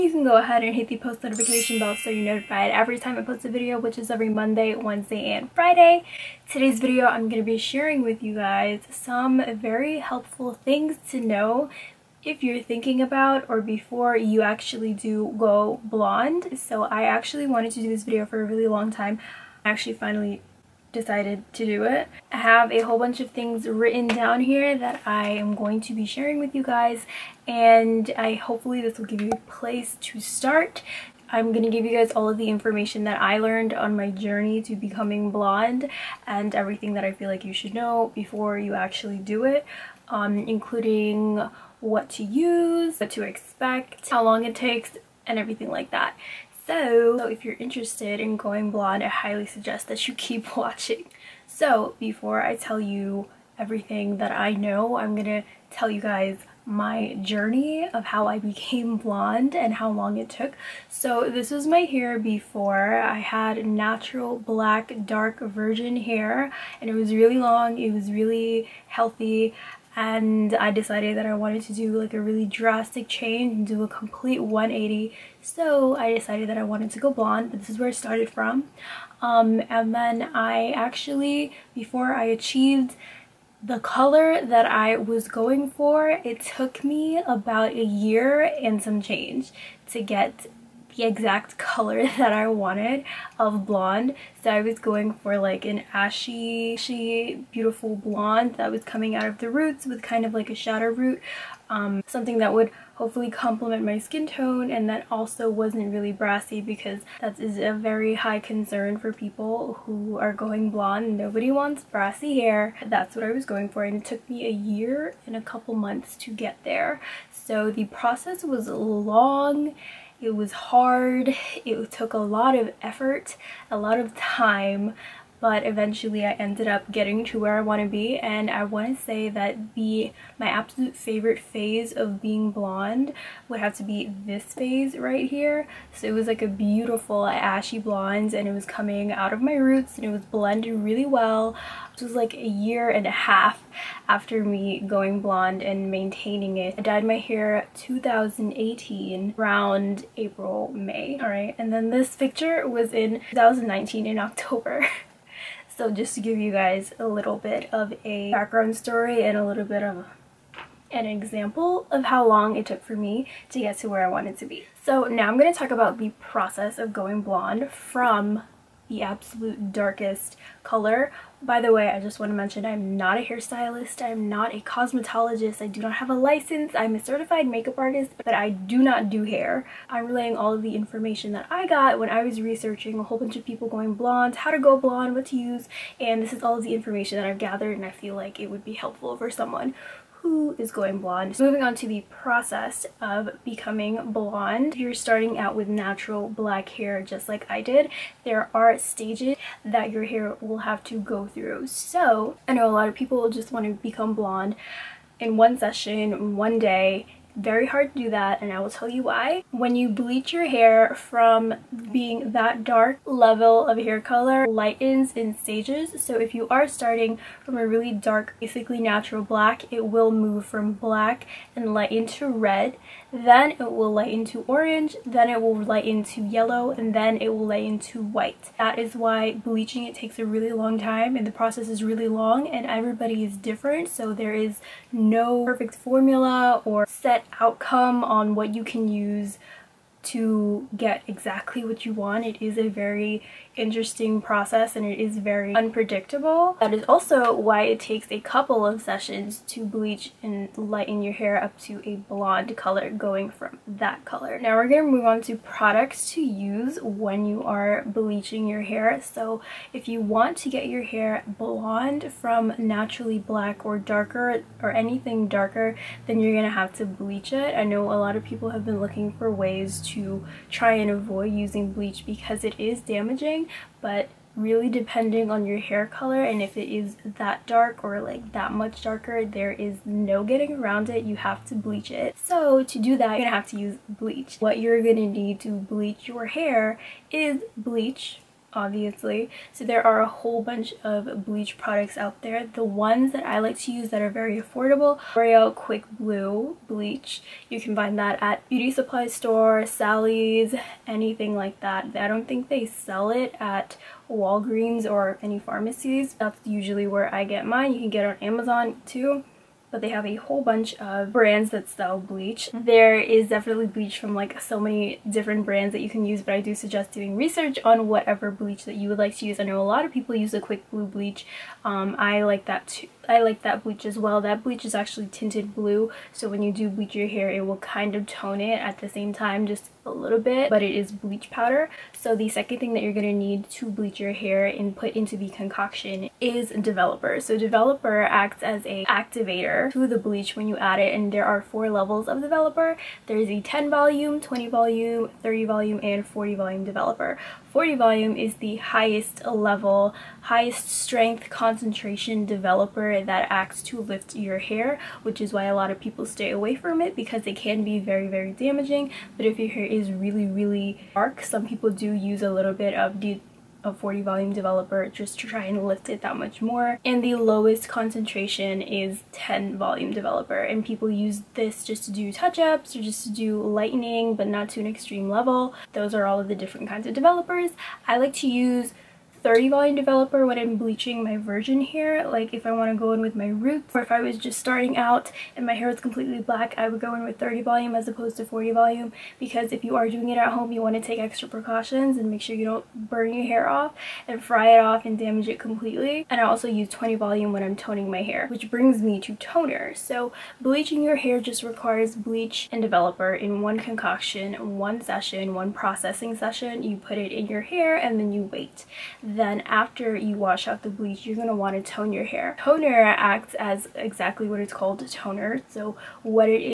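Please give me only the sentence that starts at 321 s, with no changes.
Um, I like that too, I like that bleach as well.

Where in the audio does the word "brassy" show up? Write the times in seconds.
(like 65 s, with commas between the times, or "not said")
106 s, 111 s.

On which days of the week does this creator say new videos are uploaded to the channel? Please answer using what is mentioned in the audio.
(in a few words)
Monday, Wednesday, and Friday.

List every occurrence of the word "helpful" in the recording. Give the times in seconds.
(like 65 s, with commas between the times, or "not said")
9 s, 188 s.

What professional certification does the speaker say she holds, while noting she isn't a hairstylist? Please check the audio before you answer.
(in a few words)
certified makeup artist.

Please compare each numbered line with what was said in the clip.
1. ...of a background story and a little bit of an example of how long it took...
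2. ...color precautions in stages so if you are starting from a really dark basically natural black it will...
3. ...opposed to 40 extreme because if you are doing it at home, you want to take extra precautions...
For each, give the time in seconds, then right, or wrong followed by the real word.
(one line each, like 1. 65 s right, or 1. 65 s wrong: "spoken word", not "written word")
1. 157 s right
2. 214 s wrong: "lightens", not "precautions"
3. 387 s wrong: "volume", not "extreme".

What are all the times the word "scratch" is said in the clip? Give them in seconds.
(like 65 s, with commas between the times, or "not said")
not said.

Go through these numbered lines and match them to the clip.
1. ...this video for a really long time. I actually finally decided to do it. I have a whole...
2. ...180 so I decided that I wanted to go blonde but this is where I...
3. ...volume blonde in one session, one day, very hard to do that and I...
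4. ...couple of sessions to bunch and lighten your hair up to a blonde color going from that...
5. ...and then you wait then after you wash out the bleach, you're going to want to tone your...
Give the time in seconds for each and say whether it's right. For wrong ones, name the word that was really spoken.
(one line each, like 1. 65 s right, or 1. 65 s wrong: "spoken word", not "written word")
1. 17 s right
2. 74 s right
3. 203 s wrong: "become", not "volume"
4. 248 s wrong: "bleach", not "bunch"
5. 407 s right.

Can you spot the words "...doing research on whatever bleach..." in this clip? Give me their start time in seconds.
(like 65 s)
316 s.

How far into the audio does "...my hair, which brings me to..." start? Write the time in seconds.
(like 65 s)
397 s.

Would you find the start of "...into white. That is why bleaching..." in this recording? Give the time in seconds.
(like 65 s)
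227 s.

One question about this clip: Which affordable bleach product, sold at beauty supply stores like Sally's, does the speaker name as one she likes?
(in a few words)
L'Oreal Quick Blue Bleach.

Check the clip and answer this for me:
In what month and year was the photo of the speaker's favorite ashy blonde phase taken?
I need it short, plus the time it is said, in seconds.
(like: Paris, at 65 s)
October 2019, at 153 s.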